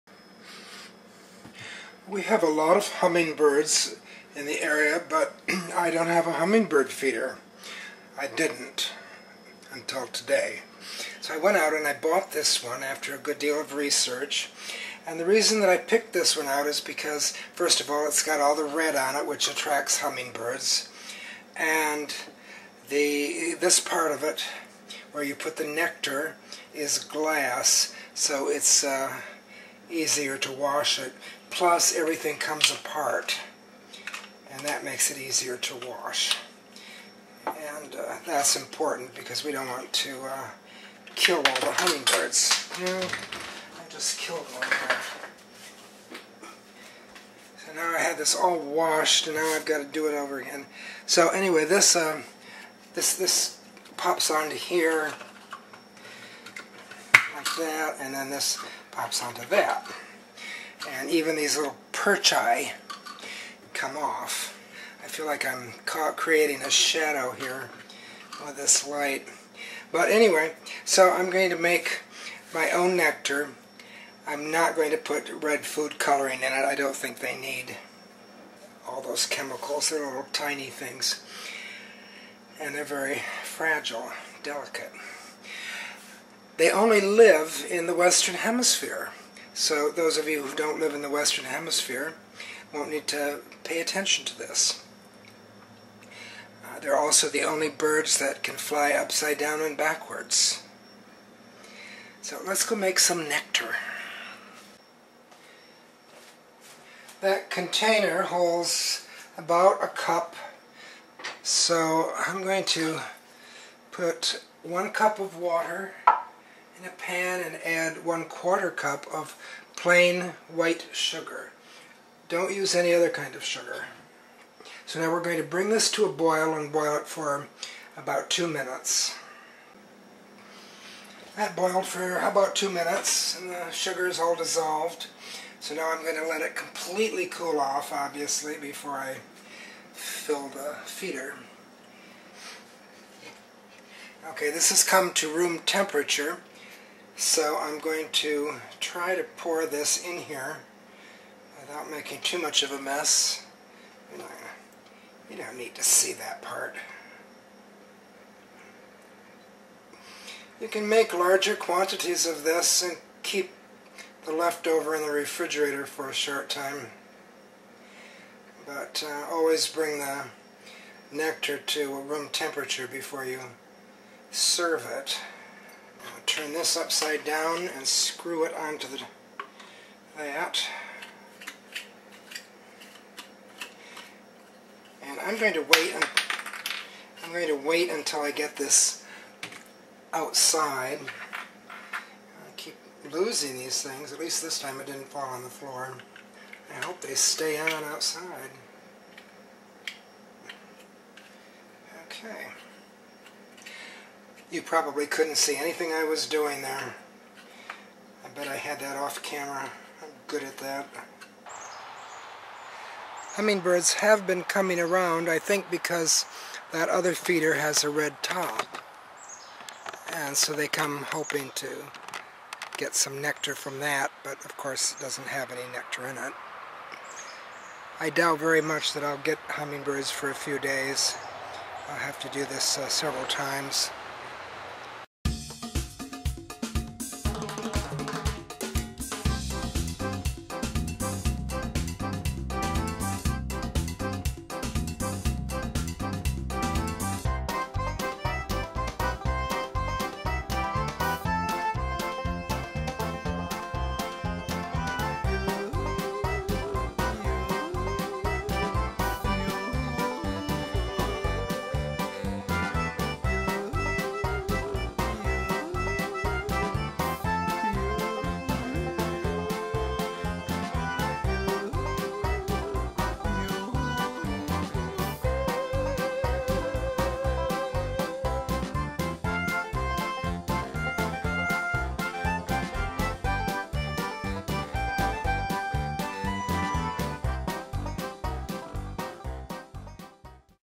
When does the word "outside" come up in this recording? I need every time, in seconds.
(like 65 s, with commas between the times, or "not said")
190 s, 197 s.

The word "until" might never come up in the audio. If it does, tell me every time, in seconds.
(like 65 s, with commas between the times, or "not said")
9 s, 187 s.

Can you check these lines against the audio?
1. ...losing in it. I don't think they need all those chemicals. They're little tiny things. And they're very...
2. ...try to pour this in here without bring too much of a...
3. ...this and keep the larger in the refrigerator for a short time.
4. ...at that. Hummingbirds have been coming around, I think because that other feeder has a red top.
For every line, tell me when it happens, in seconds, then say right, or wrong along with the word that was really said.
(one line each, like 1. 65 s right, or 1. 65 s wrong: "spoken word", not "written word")
1. 75 s wrong: "coloring", not "losing"
2. 148 s wrong: "making", not "bring"
3. 162 s wrong: "leftover", not "larger"
4. 210 s right.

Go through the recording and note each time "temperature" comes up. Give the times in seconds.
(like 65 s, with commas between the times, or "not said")
145 s, 172 s.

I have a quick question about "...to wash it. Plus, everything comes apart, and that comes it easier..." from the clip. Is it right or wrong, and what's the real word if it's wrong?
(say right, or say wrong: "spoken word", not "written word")
wrong: "makes", not "comes".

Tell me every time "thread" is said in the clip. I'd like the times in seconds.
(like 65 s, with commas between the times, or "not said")
not said.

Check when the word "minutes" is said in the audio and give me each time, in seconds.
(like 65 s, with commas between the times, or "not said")
128 s, 132 s.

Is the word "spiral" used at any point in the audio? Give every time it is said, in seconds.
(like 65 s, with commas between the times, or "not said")
not said.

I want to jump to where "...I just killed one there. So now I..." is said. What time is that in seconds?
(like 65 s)
42 s.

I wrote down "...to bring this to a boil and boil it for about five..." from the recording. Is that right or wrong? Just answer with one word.
wrong.